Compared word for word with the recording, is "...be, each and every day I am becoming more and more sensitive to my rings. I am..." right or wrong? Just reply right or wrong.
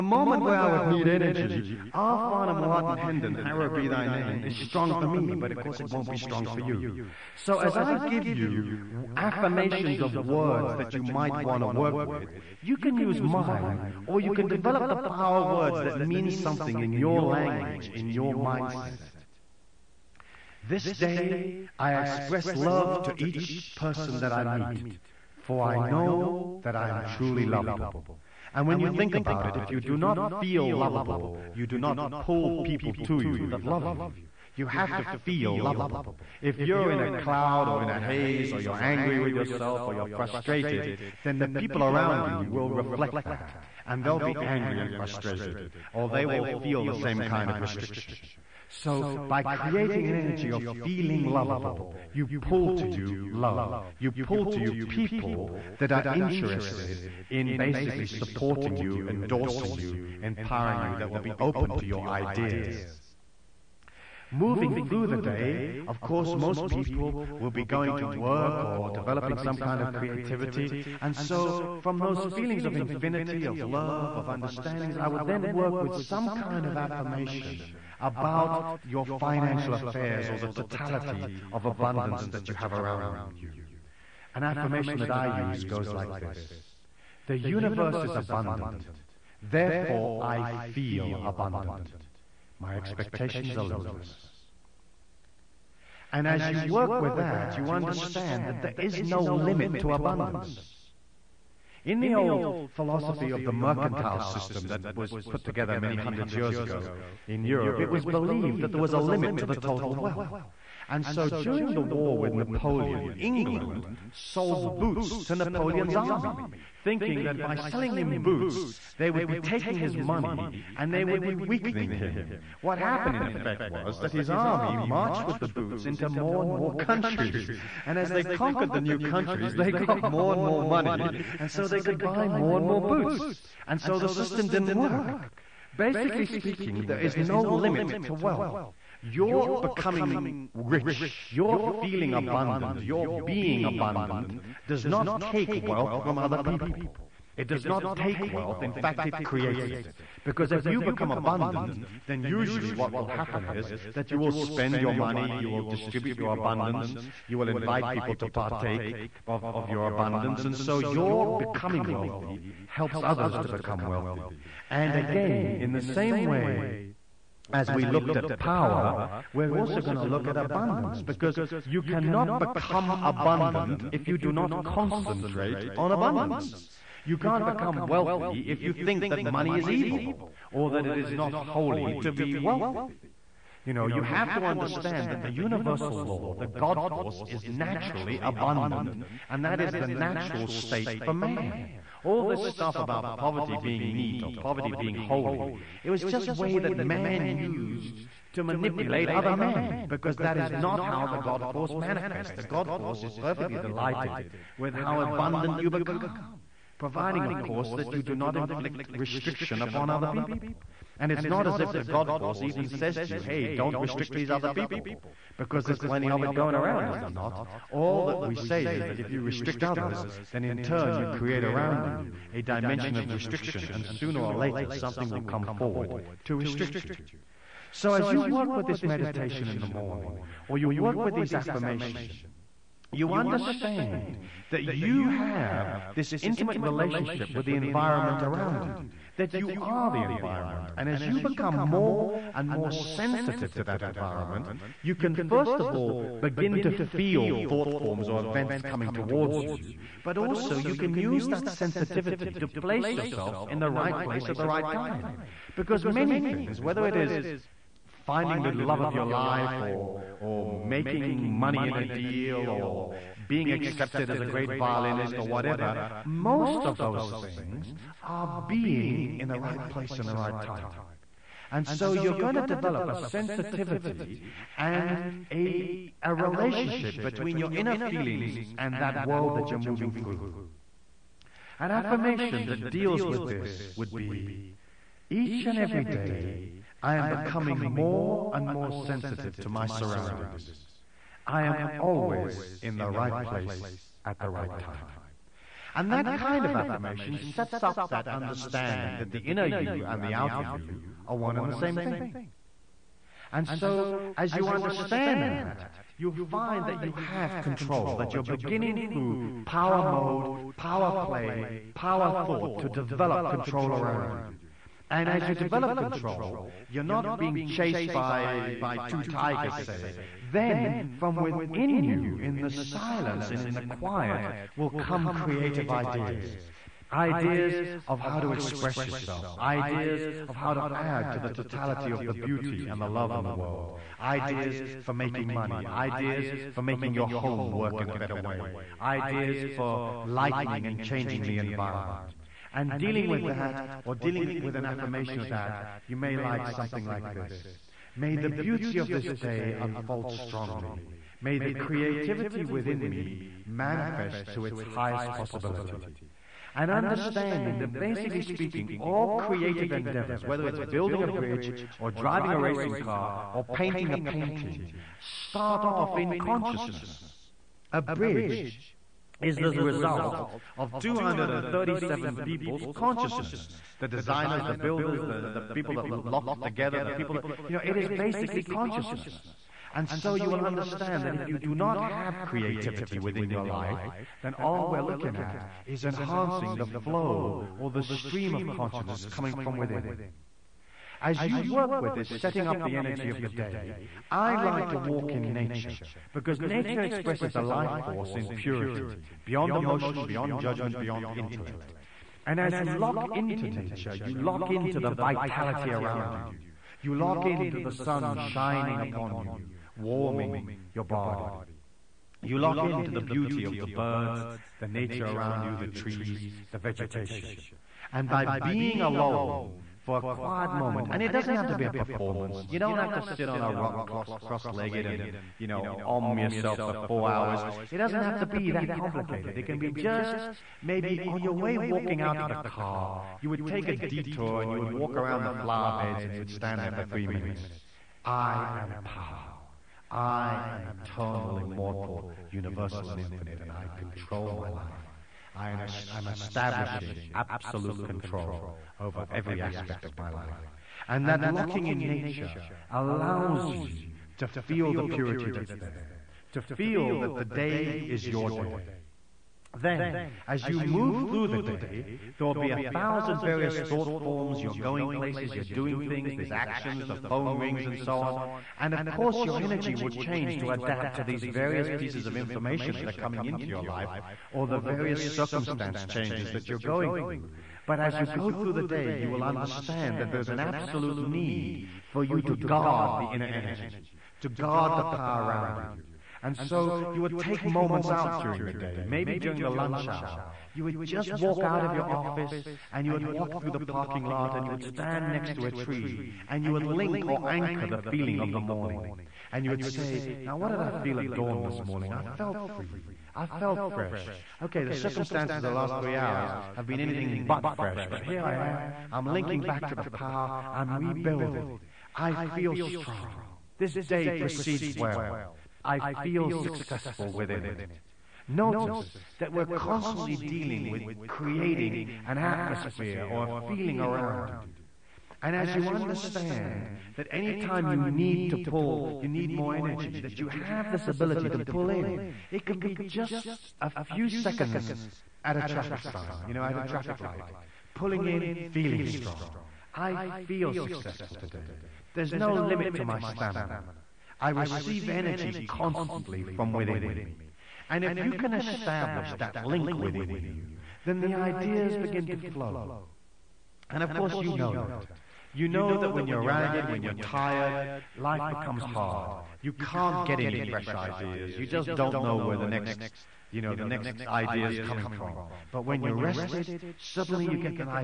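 wrong.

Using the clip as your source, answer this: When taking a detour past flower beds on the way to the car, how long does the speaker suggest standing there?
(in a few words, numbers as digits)
Three minutes.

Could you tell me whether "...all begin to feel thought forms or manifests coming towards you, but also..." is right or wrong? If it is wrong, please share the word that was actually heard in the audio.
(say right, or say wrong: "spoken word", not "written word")
wrong: "events", not "manifests".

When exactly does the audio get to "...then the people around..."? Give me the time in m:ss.
0:41.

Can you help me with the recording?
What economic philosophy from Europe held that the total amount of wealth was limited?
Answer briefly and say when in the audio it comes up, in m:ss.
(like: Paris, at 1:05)
Mercantile system, at 1:43.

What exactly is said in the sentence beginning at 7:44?
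You're going places, you're doing things, there's actions, the phone rings, and so on.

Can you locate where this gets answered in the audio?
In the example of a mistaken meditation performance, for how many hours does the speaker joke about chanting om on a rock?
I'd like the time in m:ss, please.
7:06.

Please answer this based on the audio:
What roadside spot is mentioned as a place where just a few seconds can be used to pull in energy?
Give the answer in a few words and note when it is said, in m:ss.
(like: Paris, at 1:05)
Traffic light, at 8:56.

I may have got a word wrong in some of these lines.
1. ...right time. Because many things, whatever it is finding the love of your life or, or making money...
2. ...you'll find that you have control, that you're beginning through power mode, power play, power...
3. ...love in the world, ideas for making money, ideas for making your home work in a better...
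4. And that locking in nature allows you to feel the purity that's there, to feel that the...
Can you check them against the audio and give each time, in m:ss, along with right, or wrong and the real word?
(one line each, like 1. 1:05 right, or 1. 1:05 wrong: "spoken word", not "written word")
1. 4:14 wrong: "whether", not "whatever"
2. 5:05 right
3. 5:32 right
4. 7:30 right.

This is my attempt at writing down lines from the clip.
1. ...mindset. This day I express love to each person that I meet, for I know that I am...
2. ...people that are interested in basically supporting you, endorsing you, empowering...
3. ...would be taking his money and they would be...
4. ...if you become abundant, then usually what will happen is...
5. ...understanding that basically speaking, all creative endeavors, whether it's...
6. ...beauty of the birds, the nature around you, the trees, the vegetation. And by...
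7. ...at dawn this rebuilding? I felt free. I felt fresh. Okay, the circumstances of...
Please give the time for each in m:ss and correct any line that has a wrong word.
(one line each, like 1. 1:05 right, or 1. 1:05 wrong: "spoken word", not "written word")
1. 0:18 right
2. 0:54 right
3. 1:59 right
4. 2:30 right
5. 5:56 right
6. 6:53 right
7. 8:20 wrong: "morning", not "rebuilding".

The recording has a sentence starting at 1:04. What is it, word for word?
Moving through the day, of course, most people will be going to work or developing some kind of creativity.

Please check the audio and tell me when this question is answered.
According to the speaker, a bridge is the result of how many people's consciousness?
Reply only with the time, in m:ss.
6:10.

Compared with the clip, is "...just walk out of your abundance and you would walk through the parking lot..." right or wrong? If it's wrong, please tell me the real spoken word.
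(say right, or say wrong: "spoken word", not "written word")
wrong: "office", not "abundance".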